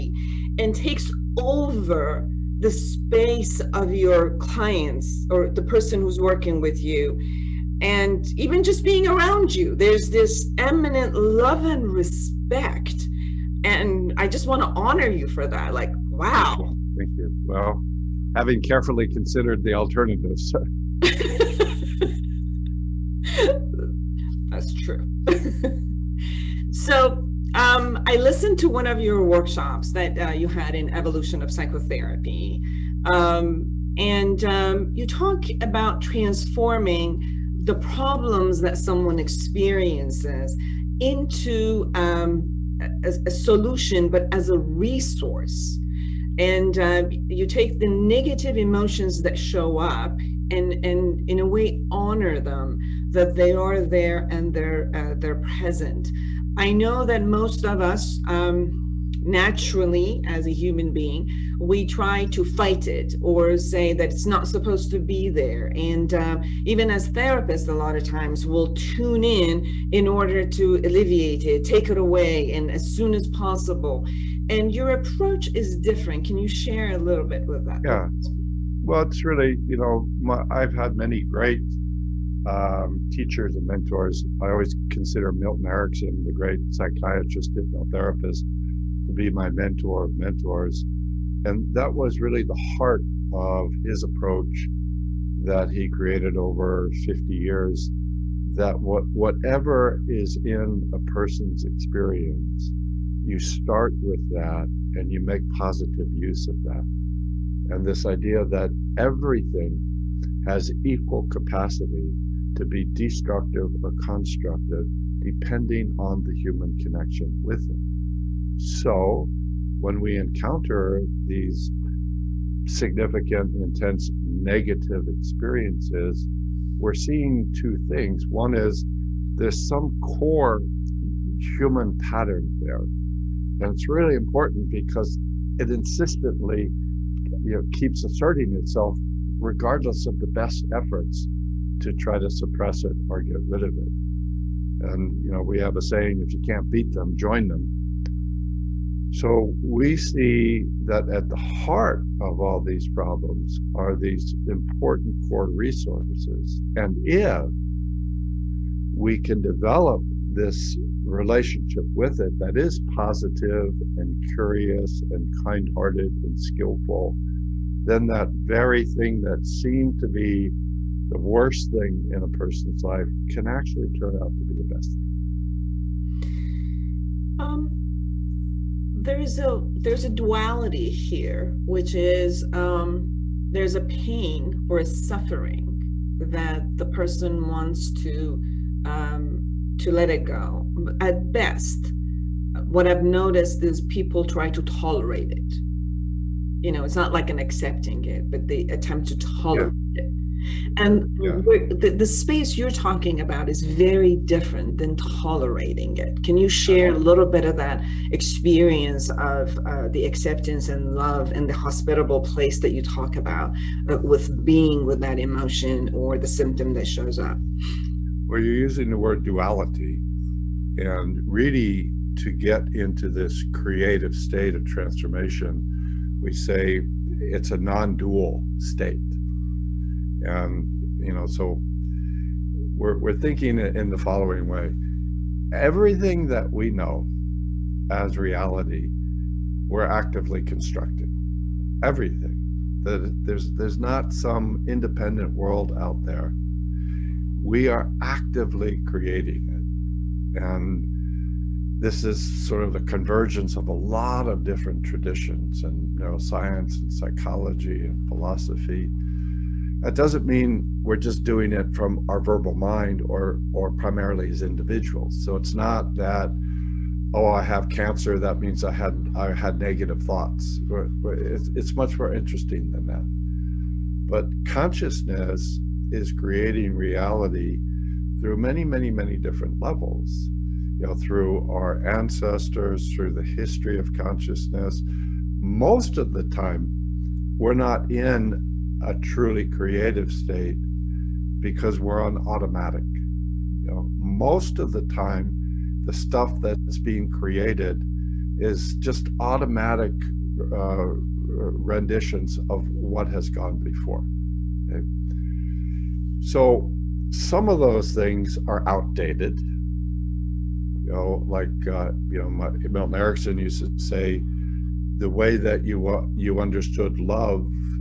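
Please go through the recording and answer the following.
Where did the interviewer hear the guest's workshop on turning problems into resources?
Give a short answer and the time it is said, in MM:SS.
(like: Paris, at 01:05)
Evolution of Psychotherapy, at 00:30.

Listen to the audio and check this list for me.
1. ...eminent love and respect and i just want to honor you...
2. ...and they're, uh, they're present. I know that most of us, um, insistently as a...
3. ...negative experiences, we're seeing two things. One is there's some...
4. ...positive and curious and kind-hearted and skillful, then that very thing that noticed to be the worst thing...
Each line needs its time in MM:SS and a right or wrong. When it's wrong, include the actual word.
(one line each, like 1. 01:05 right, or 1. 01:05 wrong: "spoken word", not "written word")
1. 00:10 right
2. 00:54 wrong: "naturally", not "insistently"
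3. 02:04 right
4. 02:42 wrong: "seemed", not "noticed".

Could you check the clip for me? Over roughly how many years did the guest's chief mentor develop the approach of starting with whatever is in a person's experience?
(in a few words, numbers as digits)
50.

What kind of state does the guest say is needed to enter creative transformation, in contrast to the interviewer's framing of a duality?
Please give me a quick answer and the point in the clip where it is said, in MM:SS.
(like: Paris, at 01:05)
Non-dual state, at 03:47.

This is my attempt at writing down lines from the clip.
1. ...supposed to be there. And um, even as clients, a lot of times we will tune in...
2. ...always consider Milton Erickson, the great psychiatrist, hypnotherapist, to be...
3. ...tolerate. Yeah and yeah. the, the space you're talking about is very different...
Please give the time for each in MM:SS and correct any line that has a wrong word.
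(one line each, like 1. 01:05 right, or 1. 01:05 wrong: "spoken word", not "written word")
1. 01:04 wrong: "therapists", not "clients"
2. 01:24 right
3. 03:19 right.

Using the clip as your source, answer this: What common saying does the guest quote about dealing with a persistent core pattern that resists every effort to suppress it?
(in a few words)
If you can't beat them, join them.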